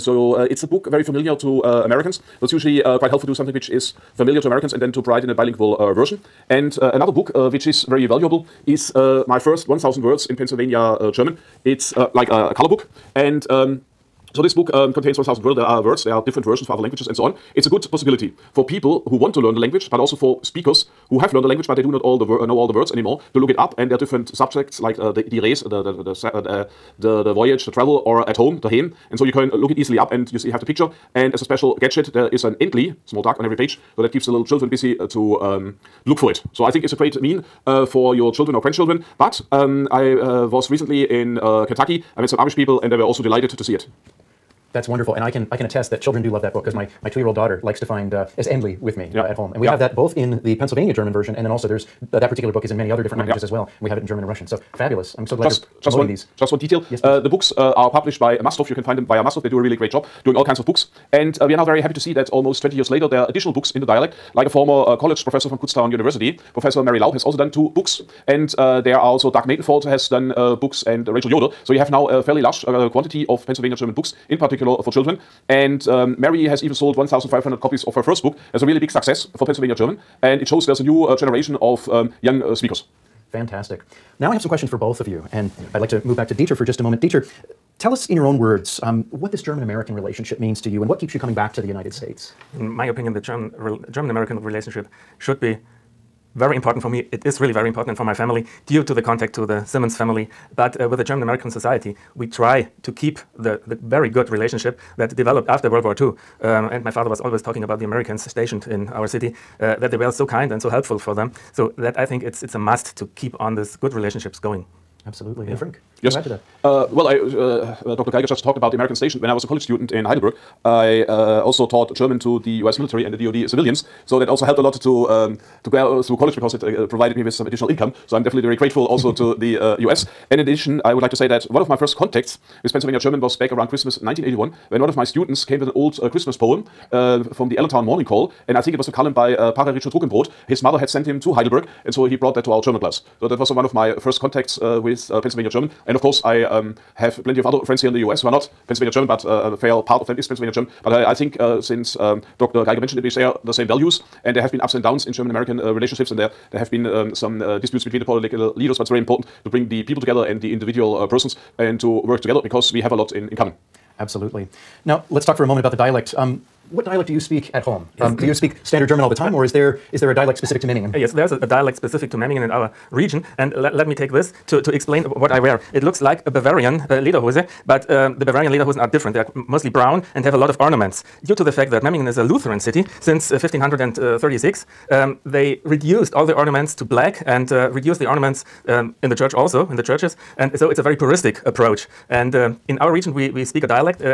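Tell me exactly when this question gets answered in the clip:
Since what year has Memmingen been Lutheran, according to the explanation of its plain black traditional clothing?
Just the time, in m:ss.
3:03.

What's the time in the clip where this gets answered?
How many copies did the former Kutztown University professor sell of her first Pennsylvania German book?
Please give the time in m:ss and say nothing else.
1:16.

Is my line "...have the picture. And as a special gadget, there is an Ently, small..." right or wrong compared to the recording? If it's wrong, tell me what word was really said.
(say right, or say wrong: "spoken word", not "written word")
right.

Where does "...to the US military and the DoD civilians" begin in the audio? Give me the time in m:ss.
2:02.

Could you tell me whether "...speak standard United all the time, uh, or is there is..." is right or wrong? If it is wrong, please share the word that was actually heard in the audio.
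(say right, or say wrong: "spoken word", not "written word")
wrong: "German", not "United".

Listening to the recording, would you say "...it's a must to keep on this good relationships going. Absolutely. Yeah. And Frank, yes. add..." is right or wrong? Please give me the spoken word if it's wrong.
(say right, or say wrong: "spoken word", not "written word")
right.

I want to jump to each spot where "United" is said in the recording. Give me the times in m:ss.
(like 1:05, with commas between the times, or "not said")
1:31.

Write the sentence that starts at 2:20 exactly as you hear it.
His mother had sent him to Heidelberg, and so he brought that to our German class.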